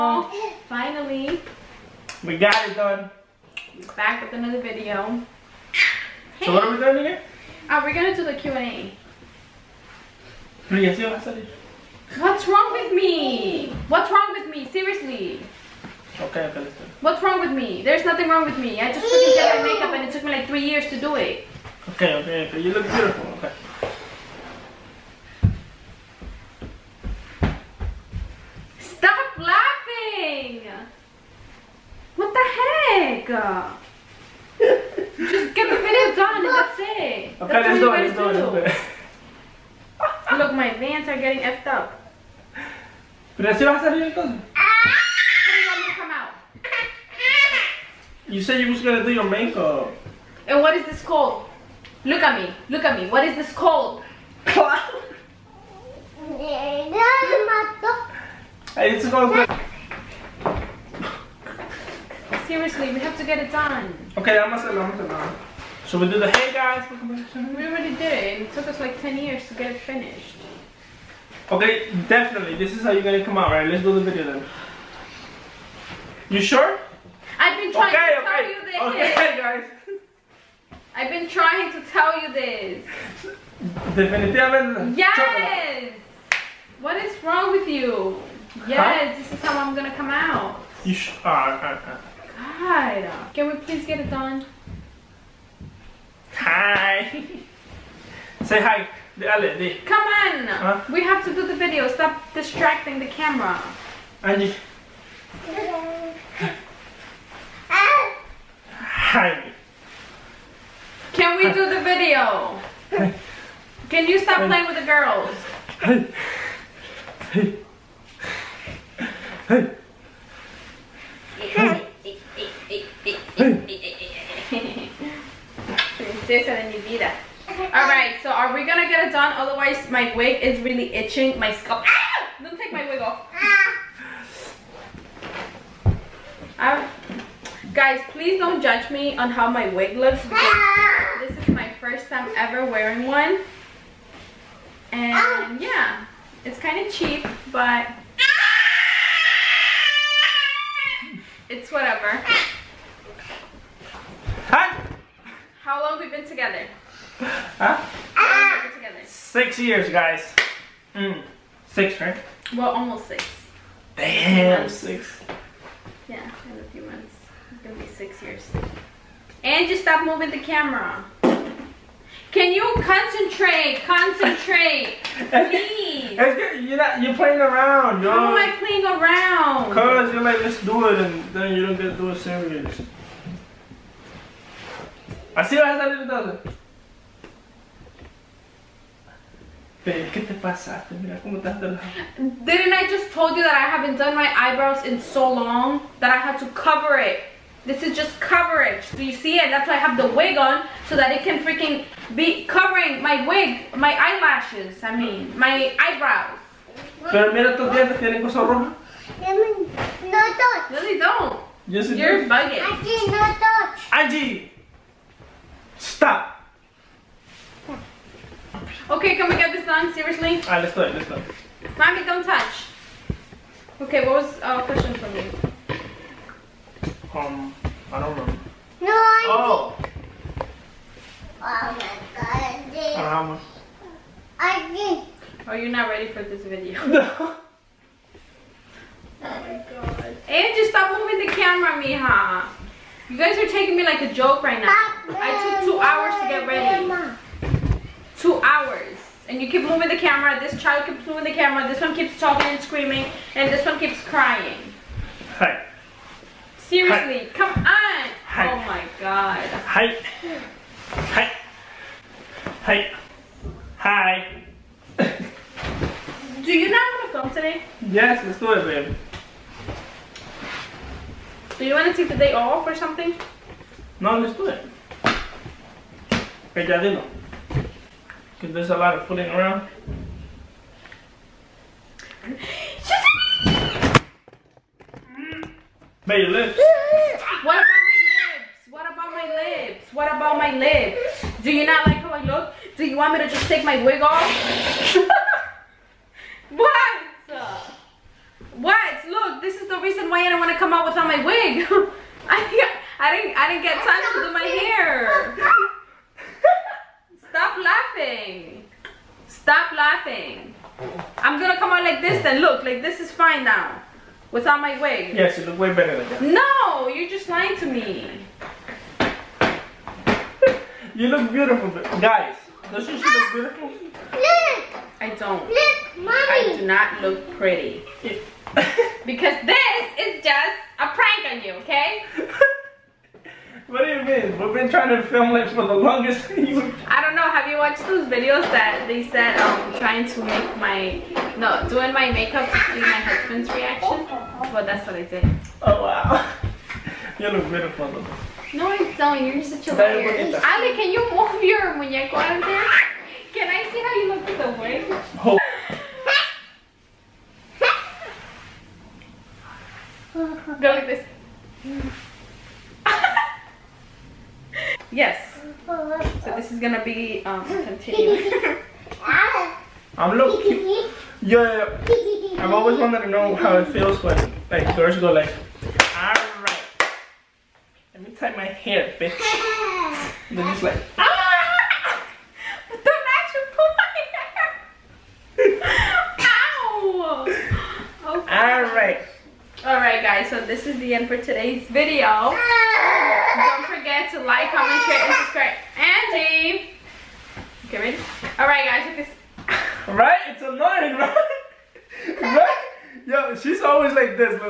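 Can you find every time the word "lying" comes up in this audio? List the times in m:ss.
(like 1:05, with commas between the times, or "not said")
5:17.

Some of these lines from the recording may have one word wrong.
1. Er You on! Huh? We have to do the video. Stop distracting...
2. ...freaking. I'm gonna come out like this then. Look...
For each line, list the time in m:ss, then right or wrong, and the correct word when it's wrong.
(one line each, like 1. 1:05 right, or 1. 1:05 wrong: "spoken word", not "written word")
1. 1:39 wrong: "Come", not "You"
2. 5:09 wrong: "laughing", not "freaking".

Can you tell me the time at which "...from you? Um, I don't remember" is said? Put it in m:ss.
3:44.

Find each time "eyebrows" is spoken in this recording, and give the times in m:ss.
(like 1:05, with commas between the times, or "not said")
3:14, 3:25.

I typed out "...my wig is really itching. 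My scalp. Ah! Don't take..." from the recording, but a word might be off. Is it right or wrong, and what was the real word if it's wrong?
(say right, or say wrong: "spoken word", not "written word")
right.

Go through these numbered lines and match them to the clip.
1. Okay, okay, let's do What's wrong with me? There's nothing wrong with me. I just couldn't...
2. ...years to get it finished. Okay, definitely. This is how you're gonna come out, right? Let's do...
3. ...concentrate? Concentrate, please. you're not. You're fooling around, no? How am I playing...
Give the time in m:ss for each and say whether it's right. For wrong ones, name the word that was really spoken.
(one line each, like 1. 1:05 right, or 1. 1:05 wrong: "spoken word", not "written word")
1. 0:16 right
2. 1:09 right
3. 2:52 wrong: "playing", not "fooling".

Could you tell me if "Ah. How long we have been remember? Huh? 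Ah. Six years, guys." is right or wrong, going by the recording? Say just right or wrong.
wrong.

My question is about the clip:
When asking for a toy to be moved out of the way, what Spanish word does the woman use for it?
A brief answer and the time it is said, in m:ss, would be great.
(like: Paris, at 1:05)
muñeco, at 5:51.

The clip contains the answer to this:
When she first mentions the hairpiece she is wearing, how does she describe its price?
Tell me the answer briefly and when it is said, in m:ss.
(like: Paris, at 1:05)
kind of cheap, at 2:26.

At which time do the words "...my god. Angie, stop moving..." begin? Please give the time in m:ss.
3:59.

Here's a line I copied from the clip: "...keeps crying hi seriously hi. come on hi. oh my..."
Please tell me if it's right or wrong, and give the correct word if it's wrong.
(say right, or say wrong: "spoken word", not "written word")
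right.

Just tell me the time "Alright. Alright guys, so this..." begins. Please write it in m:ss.
6:28.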